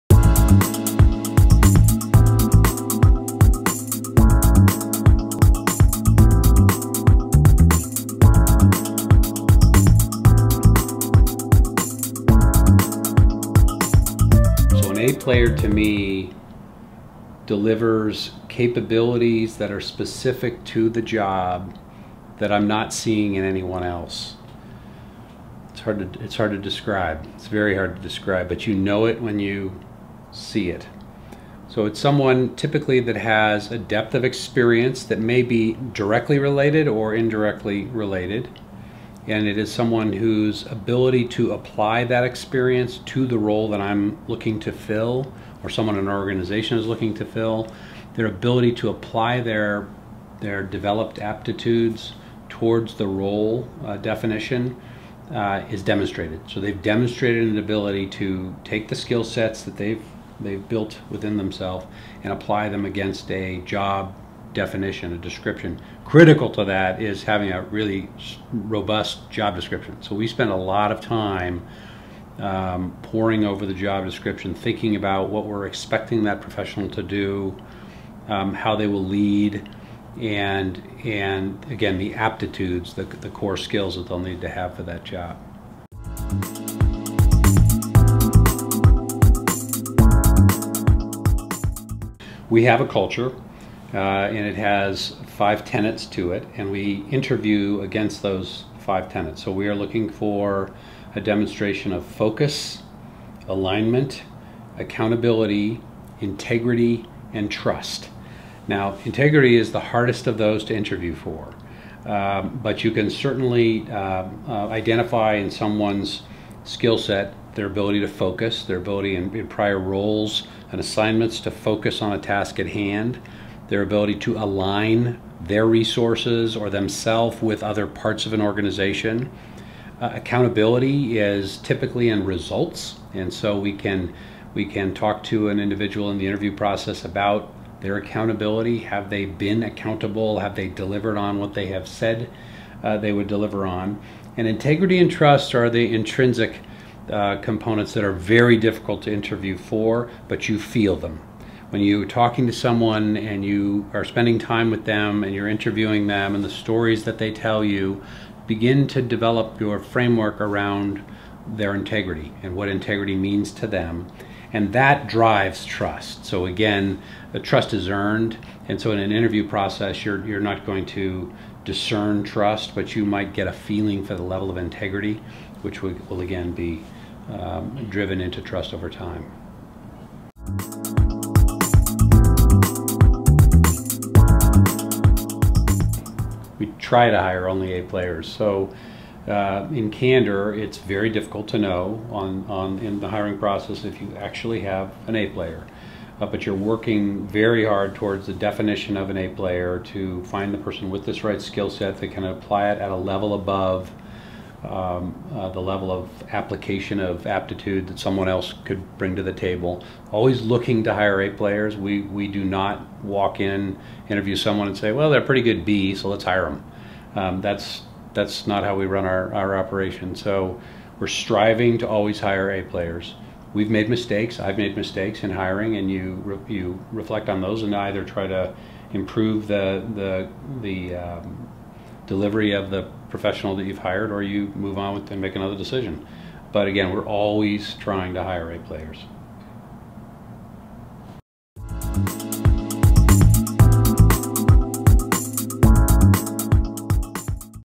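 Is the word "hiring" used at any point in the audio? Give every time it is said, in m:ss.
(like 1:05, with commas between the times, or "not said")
3:13, 3:45.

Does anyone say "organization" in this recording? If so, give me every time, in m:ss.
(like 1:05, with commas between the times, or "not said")
0:46, 2:08.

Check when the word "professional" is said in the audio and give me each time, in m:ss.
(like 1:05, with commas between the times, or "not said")
1:16, 3:53.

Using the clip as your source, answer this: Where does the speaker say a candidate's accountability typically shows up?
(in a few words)
Results.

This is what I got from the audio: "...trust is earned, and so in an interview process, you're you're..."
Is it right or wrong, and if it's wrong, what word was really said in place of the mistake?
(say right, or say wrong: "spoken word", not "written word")
right.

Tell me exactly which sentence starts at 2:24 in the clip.
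And integrity and trust are the intrinsic uh, components that are very difficult to interview for, but you feel them.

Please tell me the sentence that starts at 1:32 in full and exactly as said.
we have a culture, uh, and it has five tenets to it, and we interview against those five tenets.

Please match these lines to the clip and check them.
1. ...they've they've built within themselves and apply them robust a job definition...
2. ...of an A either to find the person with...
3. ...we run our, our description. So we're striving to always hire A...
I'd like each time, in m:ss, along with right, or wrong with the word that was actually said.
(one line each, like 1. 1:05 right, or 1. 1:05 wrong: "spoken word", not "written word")
1. 0:59 wrong: "against", not "robust"
2. 3:18 wrong: "player", not "either"
3. 3:38 wrong: "operation", not "description".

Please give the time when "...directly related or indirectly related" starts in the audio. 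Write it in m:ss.
0:35.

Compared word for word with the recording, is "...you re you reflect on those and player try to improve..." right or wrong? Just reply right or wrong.
wrong.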